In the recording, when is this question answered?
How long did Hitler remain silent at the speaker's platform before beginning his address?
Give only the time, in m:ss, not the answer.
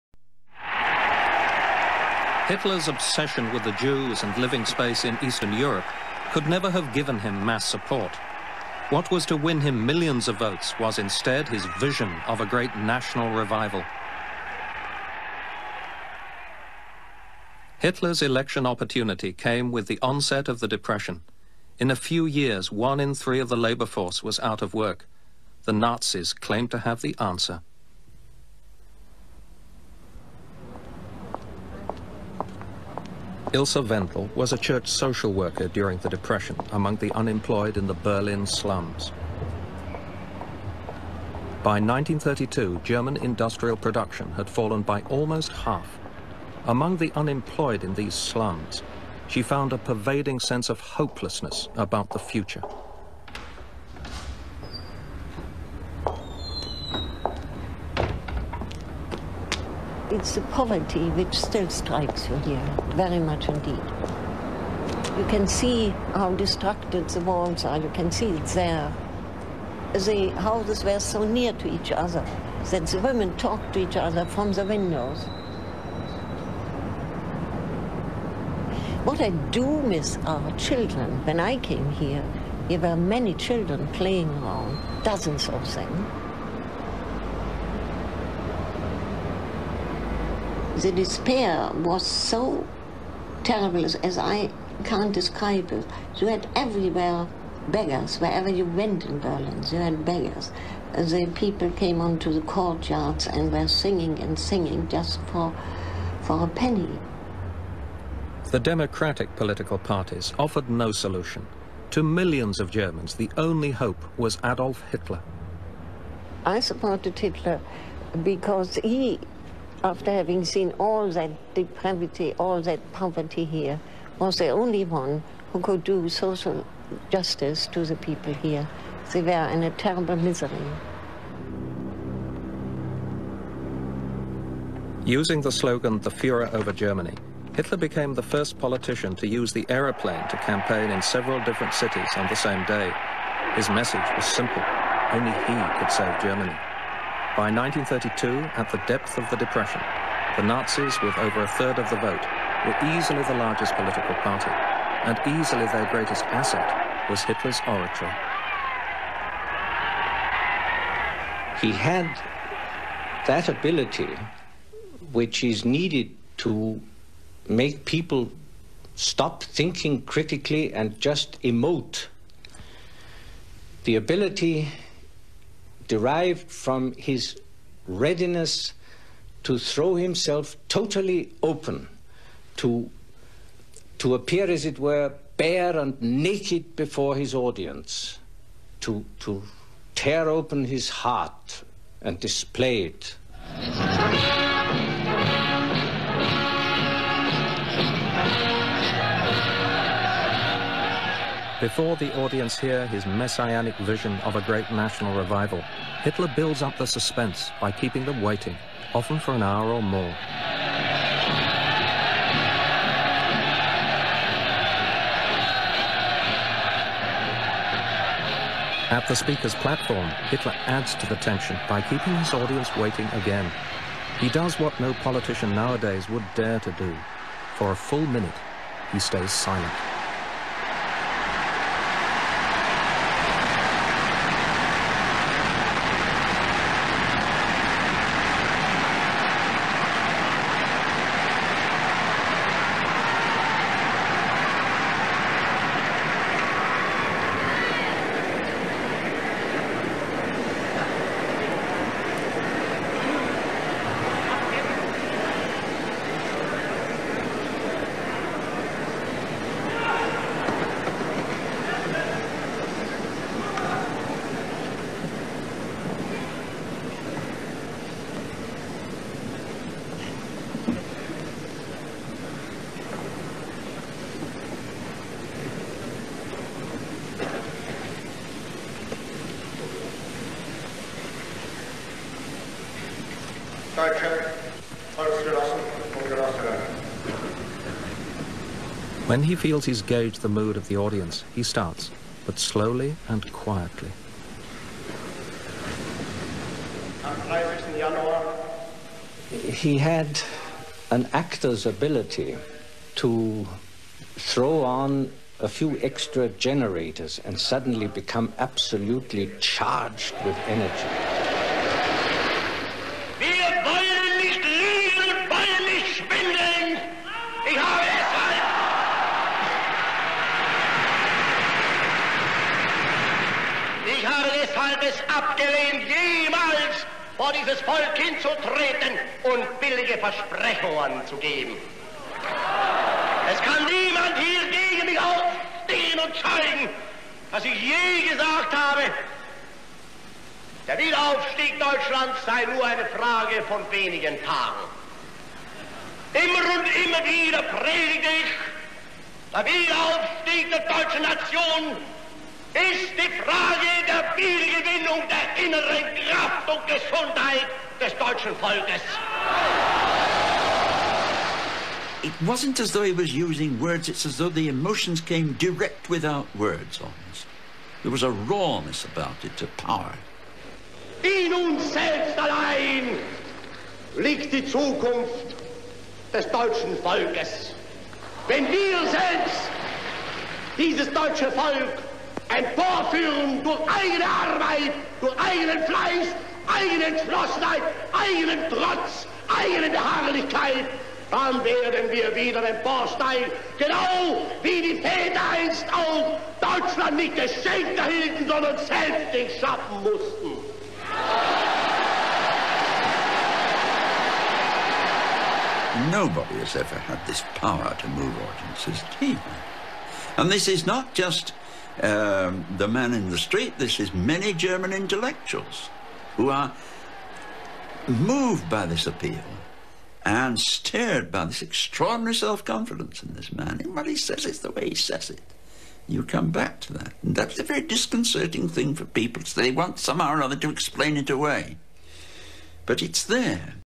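3:47.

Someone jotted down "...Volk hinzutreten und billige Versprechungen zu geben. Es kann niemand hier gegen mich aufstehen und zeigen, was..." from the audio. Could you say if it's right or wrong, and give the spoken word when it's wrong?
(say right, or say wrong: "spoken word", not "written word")
right.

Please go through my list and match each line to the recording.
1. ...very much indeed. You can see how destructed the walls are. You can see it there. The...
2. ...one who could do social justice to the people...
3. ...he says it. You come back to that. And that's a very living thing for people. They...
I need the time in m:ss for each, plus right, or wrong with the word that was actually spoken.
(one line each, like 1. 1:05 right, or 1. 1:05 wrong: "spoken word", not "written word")
1. 1:02 right
2. 2:04 right
3. 7:04 wrong: "disconcerting", not "living".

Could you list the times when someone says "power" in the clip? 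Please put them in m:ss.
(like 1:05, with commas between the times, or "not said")
6:09, 6:47.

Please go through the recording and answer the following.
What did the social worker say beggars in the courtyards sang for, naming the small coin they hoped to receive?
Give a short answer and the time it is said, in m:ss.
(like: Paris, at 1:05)
a penny, at 1:46.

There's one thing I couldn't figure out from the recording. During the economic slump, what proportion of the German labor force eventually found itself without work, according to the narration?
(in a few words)
one in three.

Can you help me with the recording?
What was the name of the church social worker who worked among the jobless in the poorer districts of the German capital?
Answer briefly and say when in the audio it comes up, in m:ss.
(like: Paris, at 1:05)
Ilse Wendel, at 0:33.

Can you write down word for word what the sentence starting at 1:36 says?
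You had everywhere beggars, wherever you went in Berlin, you had beggars.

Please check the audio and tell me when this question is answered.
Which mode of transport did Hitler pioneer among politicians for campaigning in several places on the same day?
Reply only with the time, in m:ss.
2:19.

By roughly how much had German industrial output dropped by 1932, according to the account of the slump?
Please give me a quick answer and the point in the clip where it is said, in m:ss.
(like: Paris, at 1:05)
almost half, at 0:45.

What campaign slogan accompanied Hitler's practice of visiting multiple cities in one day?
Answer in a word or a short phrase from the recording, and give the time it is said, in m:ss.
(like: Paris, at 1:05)
the Fuhrer over Germany, at 2:15.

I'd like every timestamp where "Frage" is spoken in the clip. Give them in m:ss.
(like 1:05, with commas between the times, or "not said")
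5:42, 5:53.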